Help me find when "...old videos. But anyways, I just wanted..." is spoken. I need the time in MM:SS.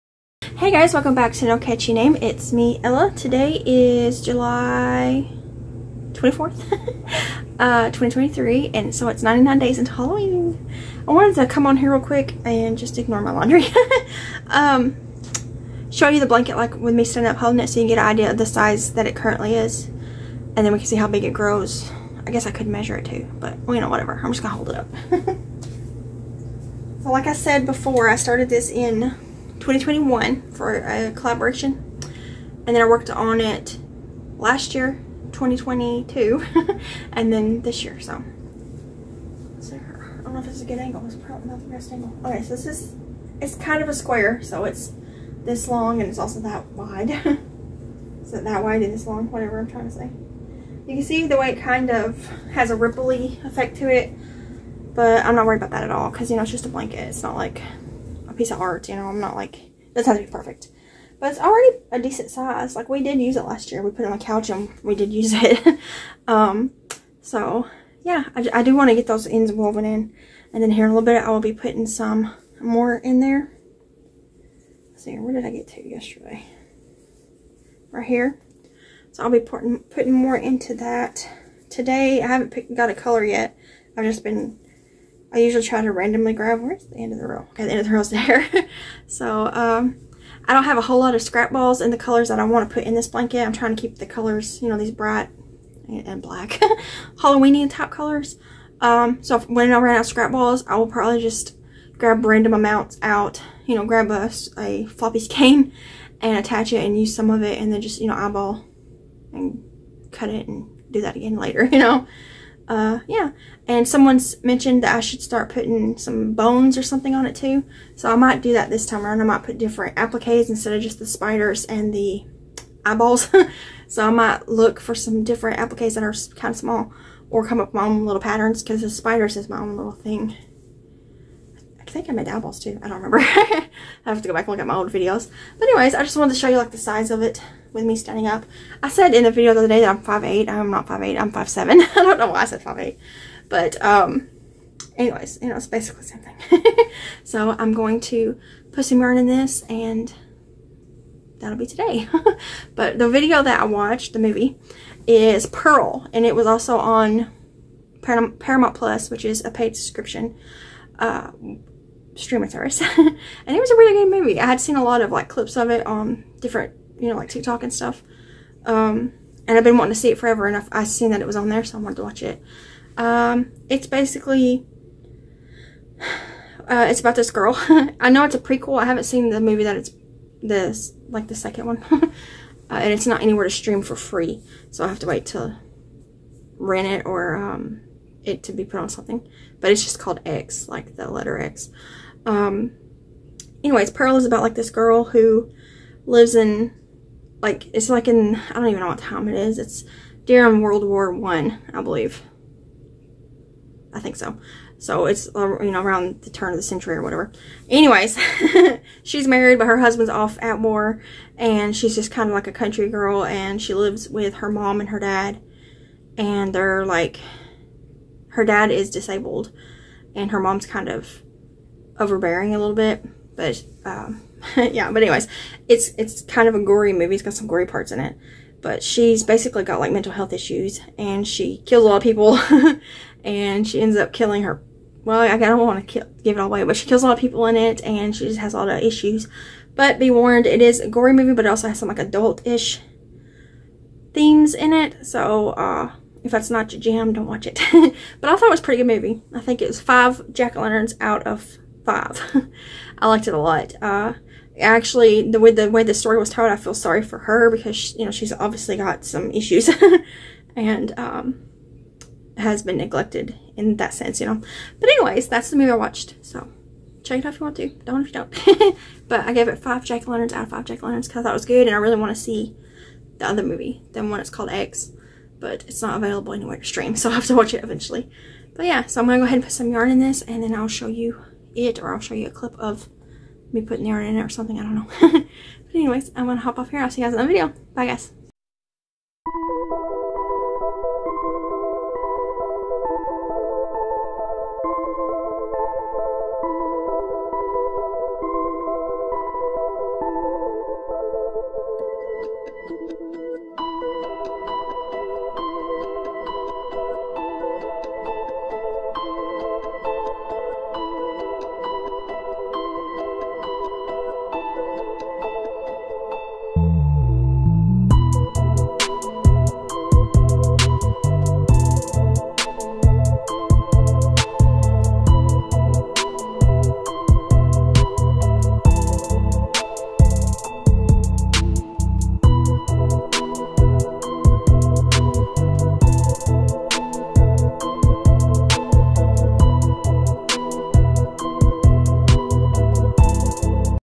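02:14.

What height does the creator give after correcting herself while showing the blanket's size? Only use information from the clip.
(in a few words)
5'7".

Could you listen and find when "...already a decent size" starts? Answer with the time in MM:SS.
01:01.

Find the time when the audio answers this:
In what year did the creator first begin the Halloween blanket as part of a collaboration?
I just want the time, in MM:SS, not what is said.
00:29.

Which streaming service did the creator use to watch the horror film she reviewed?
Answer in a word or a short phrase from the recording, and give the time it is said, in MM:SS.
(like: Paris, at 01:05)
Paramount Plus, at 02:38.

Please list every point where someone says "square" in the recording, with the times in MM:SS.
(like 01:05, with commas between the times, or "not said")
00:43.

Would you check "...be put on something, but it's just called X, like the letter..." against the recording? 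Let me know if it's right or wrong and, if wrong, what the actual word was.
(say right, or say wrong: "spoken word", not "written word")
right.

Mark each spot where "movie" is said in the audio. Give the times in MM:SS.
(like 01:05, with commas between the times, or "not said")
02:34, 02:44, 02:59, 03:46, 04:01, 04:08, 04:25, 04:33.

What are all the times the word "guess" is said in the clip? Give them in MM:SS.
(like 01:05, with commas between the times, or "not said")
00:22.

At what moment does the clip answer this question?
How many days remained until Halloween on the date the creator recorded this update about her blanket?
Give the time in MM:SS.
00:09.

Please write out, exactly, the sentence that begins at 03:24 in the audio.
So it's, uh, you know, around the turn of the century or whatever.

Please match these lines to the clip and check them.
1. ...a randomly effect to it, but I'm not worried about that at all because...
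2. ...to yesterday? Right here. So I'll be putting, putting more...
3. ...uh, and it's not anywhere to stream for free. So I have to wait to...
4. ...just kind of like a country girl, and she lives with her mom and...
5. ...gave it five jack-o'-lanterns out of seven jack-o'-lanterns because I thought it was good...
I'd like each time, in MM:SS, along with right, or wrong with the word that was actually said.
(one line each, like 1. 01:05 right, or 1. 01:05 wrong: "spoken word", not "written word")
1. 00:52 wrong: "ripply", not "randomly"
2. 01:15 right
3. 03:01 right
4. 03:31 right
5. 04:29 wrong: "five", not "seven".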